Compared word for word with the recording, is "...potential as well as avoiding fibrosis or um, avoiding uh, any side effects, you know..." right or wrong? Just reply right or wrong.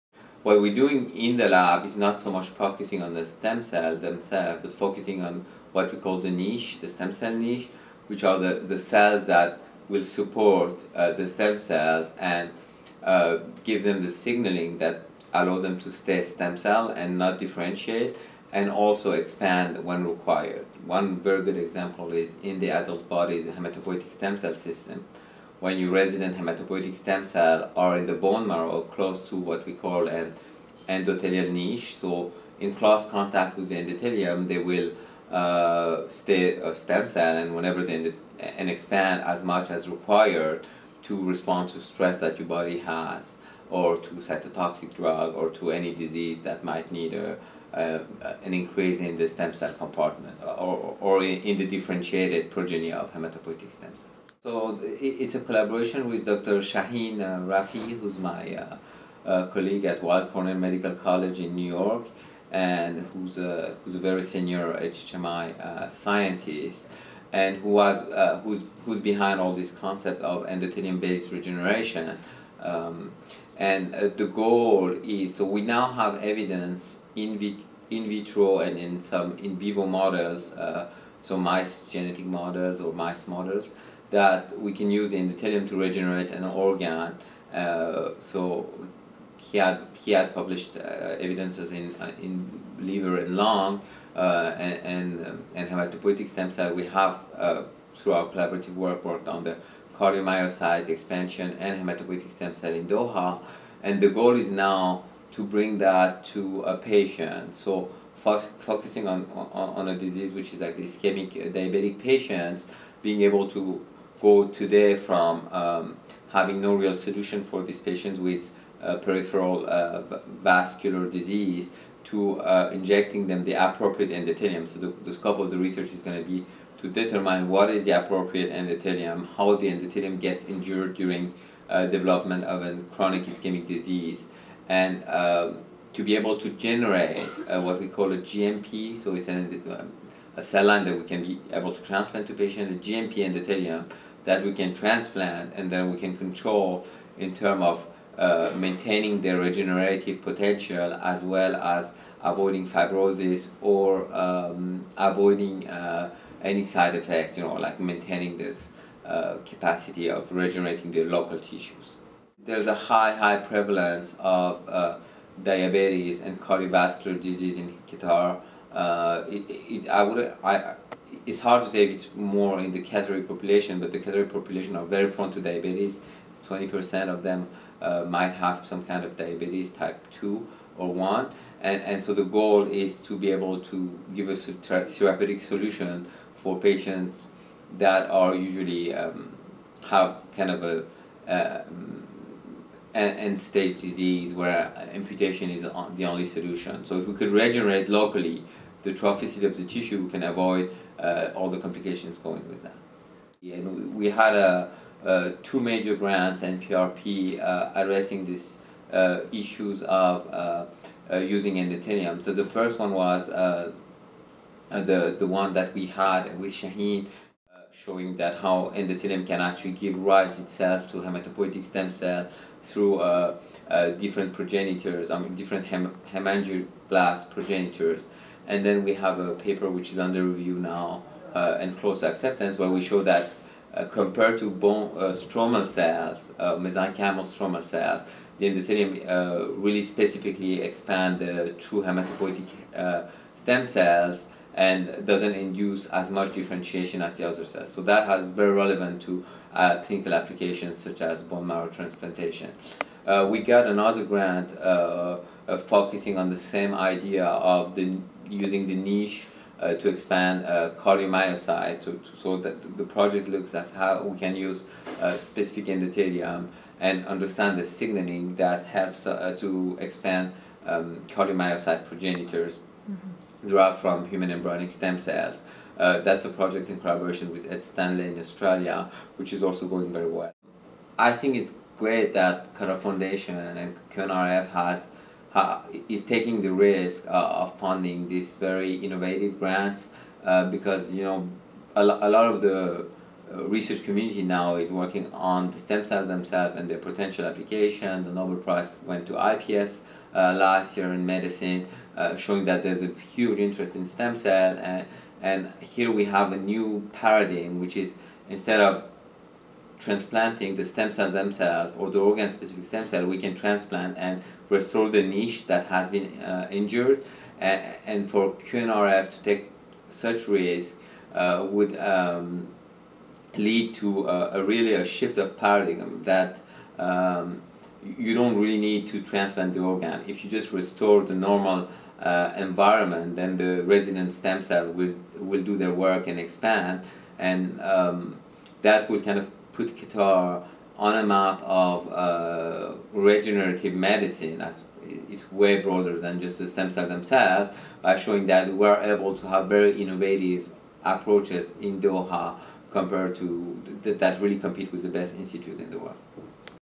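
right.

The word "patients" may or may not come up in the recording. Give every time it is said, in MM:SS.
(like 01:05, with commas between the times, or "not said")
01:46, 01:52, 01:57, 02:22, 03:06.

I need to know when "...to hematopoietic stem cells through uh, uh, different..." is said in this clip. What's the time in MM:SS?
03:40.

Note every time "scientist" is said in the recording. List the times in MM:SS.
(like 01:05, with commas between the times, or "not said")
01:06.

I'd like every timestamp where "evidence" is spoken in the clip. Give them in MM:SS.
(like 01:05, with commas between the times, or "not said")
01:16, 01:31.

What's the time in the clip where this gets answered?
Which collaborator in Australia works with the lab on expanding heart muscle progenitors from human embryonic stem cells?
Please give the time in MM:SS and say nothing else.
04:37.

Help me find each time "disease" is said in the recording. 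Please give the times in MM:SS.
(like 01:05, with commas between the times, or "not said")
00:45, 01:49, 02:01, 02:13, 02:47, 03:13.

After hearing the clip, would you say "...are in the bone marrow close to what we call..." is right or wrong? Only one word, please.
right.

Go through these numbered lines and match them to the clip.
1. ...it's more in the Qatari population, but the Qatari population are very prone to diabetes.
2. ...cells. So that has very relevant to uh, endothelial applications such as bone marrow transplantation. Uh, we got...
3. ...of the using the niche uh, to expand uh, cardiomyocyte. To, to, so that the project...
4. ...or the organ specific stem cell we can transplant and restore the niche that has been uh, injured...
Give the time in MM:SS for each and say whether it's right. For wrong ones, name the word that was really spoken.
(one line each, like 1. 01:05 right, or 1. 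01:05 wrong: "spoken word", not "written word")
1. 02:51 right
2. 04:07 wrong: "clinical", not "endothelial"
3. 04:17 right
4. 05:11 right.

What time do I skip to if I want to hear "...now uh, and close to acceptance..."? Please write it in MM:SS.
03:50.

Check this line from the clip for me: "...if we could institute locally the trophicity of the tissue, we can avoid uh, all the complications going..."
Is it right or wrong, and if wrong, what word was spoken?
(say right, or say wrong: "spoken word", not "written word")
wrong: "regenerate", not "institute".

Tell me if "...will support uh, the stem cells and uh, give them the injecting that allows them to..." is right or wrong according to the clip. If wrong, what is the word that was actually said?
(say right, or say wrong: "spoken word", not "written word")
wrong: "signaling", not "injecting".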